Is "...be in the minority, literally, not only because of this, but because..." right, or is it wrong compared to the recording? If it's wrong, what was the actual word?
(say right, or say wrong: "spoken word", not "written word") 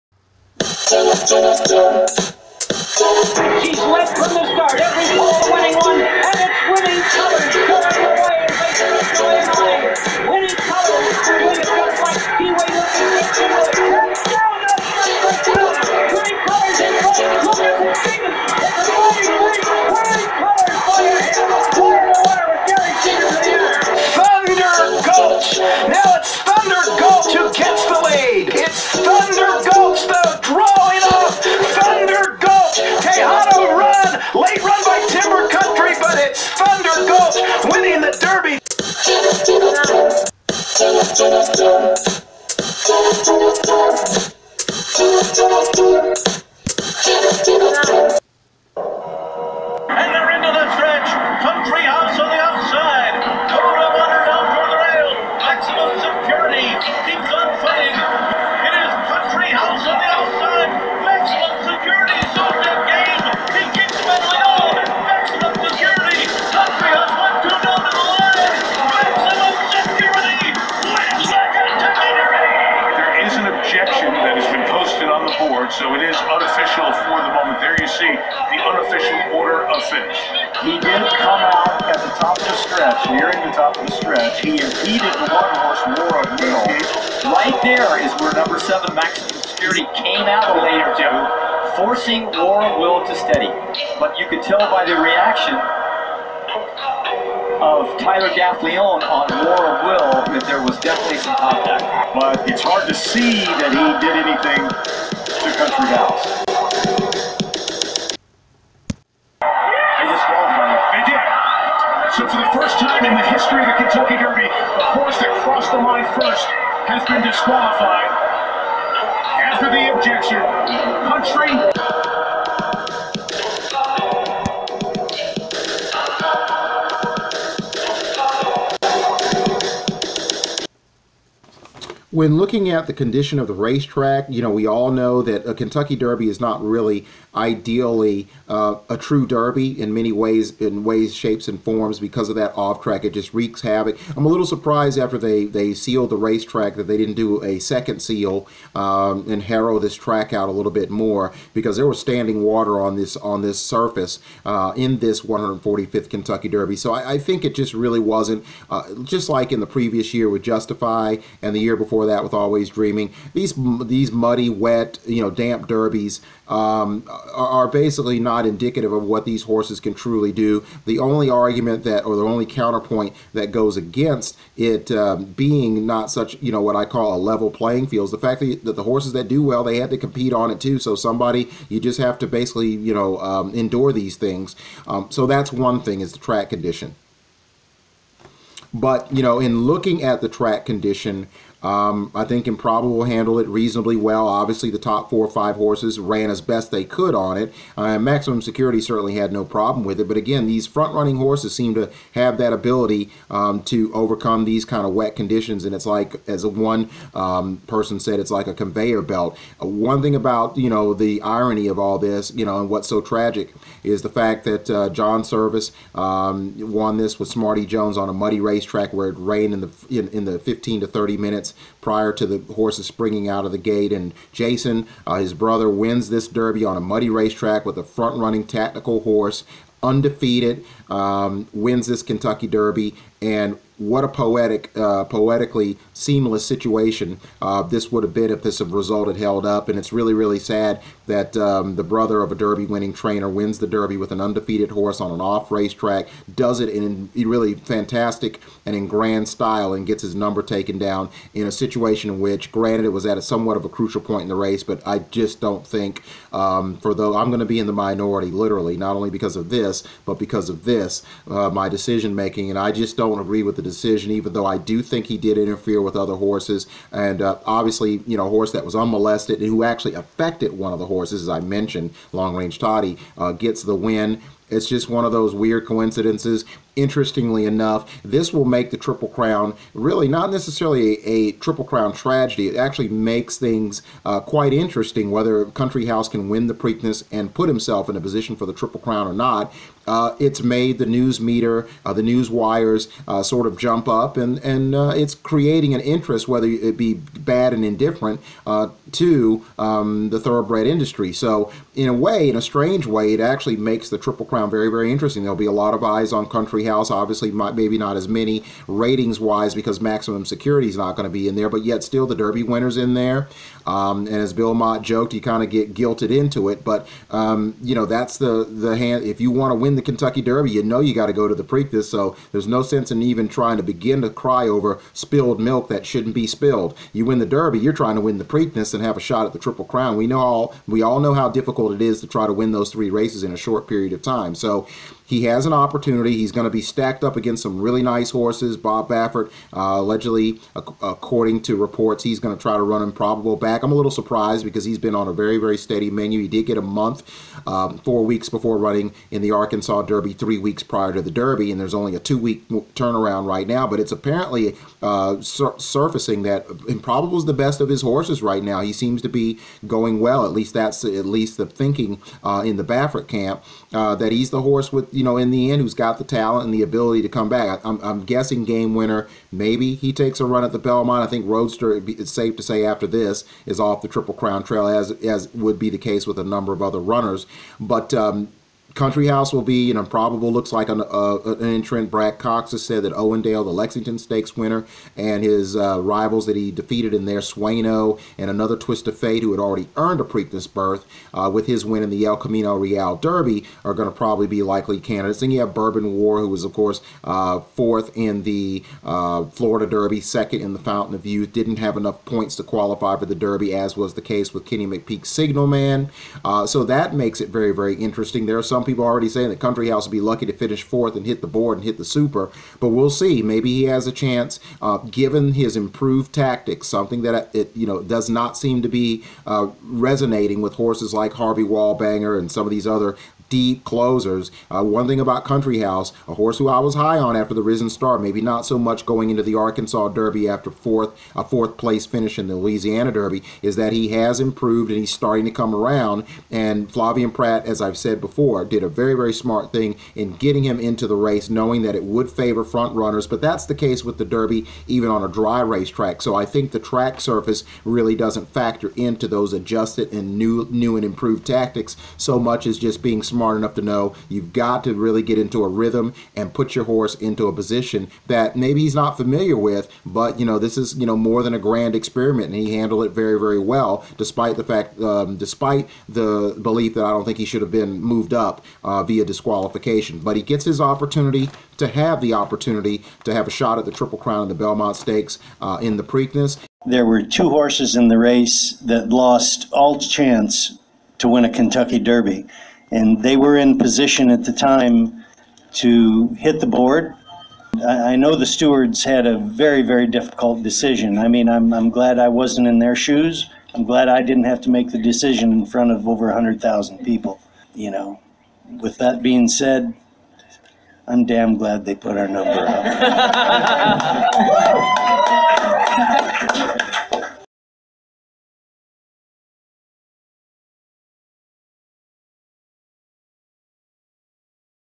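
right.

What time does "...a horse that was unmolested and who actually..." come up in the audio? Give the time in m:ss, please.
4:28.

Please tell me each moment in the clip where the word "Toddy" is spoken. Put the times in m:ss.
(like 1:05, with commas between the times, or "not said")
4:32.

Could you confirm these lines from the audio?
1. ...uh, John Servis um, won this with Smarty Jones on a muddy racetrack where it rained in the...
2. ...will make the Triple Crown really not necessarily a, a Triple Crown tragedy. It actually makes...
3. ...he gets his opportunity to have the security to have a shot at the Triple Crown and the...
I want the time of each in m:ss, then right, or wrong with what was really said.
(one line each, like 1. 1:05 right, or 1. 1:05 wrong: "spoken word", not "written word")
1. 3:34 right
2. 4:38 right
3. 7:50 wrong: "opportunity", not "security".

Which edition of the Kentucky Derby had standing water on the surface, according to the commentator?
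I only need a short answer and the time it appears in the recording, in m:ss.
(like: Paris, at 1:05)
145th, at 2:35.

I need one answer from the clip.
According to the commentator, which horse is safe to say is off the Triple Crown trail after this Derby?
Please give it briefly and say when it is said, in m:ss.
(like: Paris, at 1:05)
Roadster, at 6:11.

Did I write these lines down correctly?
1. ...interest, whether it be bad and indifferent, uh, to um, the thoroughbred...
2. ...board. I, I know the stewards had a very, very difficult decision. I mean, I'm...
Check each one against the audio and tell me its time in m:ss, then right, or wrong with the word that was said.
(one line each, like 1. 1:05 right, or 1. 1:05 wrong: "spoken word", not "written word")
1. 4:55 right
2. 8:06 right.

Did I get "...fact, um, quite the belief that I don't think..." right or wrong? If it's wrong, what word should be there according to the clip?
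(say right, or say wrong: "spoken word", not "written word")
wrong: "despite", not "quite".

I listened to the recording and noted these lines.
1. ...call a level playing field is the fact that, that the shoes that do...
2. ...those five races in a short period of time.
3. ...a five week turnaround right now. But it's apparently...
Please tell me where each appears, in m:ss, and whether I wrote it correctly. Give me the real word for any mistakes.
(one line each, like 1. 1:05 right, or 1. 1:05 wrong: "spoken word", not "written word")
1. 2:56 wrong: "horses", not "shoes"
2. 5:32 wrong: "three", not "five"
3. 5:51 wrong: "two", not "five".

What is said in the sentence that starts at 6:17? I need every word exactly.
But um, Country House will be, you know, probable.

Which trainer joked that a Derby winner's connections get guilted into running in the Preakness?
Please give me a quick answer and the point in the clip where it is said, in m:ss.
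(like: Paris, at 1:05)
Bill Mott, at 5:14.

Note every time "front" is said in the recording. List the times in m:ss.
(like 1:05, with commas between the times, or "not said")
3:20, 3:47, 7:22, 8:15.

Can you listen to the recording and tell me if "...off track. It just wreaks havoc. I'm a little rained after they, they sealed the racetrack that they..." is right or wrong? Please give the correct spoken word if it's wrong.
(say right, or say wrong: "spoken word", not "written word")
wrong: "surprised", not "rained".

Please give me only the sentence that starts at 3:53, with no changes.
And what a poetic, uh, poetically seamless situation uh, this would have been if this result had held up.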